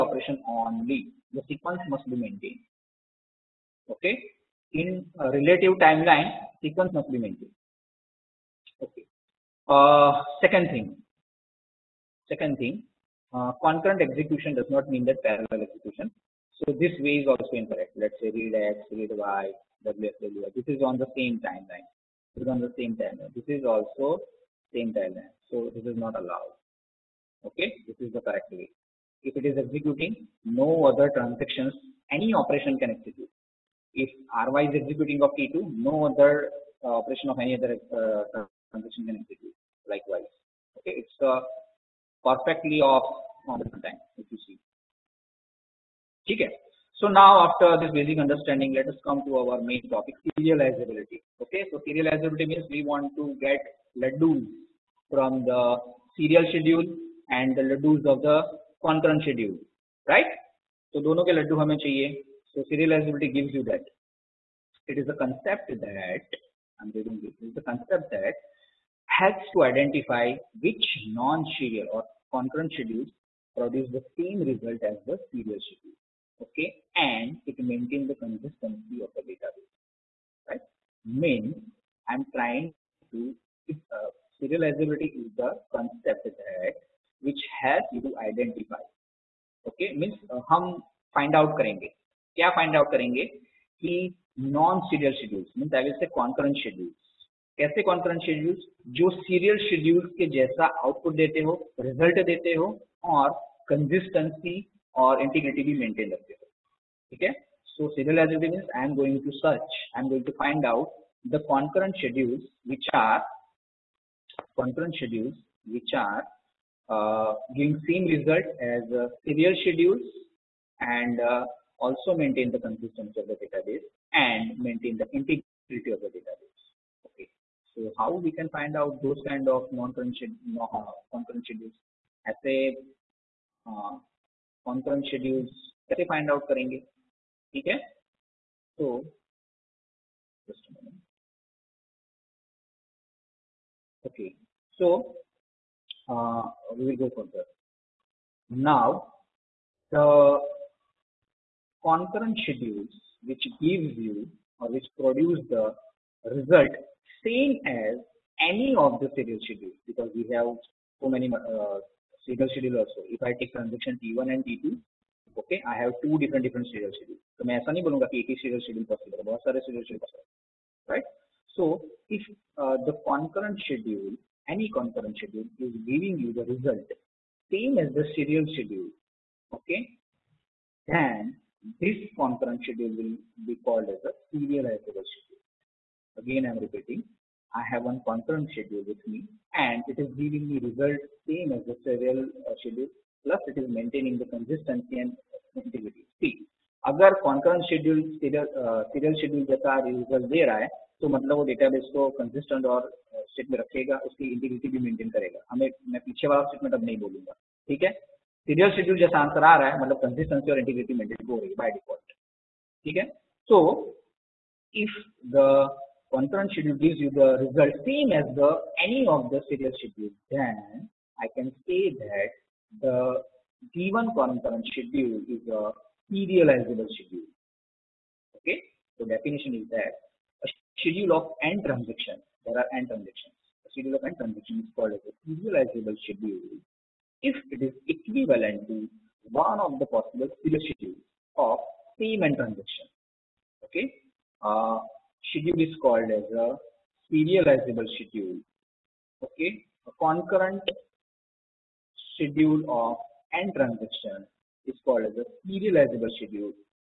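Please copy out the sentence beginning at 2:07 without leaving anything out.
Okay, so how we can find out those kind of non-concurrent schedules?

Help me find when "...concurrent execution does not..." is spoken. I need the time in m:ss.
0:13.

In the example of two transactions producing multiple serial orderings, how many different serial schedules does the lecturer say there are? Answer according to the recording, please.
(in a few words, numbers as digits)
2.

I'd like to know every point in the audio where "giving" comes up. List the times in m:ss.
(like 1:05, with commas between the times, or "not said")
1:57, 2:55, 3:10.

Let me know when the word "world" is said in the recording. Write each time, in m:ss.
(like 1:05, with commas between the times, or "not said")
not said.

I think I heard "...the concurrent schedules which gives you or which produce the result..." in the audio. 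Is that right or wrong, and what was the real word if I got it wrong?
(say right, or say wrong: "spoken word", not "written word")
right.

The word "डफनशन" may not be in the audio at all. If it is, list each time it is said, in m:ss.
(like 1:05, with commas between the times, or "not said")
3:49.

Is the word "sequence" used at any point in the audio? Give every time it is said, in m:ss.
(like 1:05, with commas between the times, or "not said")
0:01, 0:06.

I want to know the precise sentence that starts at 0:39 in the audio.
Likewise, okay, it's uh, perfectly off on the time if you see.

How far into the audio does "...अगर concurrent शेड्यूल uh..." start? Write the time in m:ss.
3:16.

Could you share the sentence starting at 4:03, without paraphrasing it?
Okay, uh, schedule is called as a serializable schedule.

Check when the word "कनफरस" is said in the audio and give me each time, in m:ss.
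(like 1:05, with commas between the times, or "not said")
3:36, 3:44.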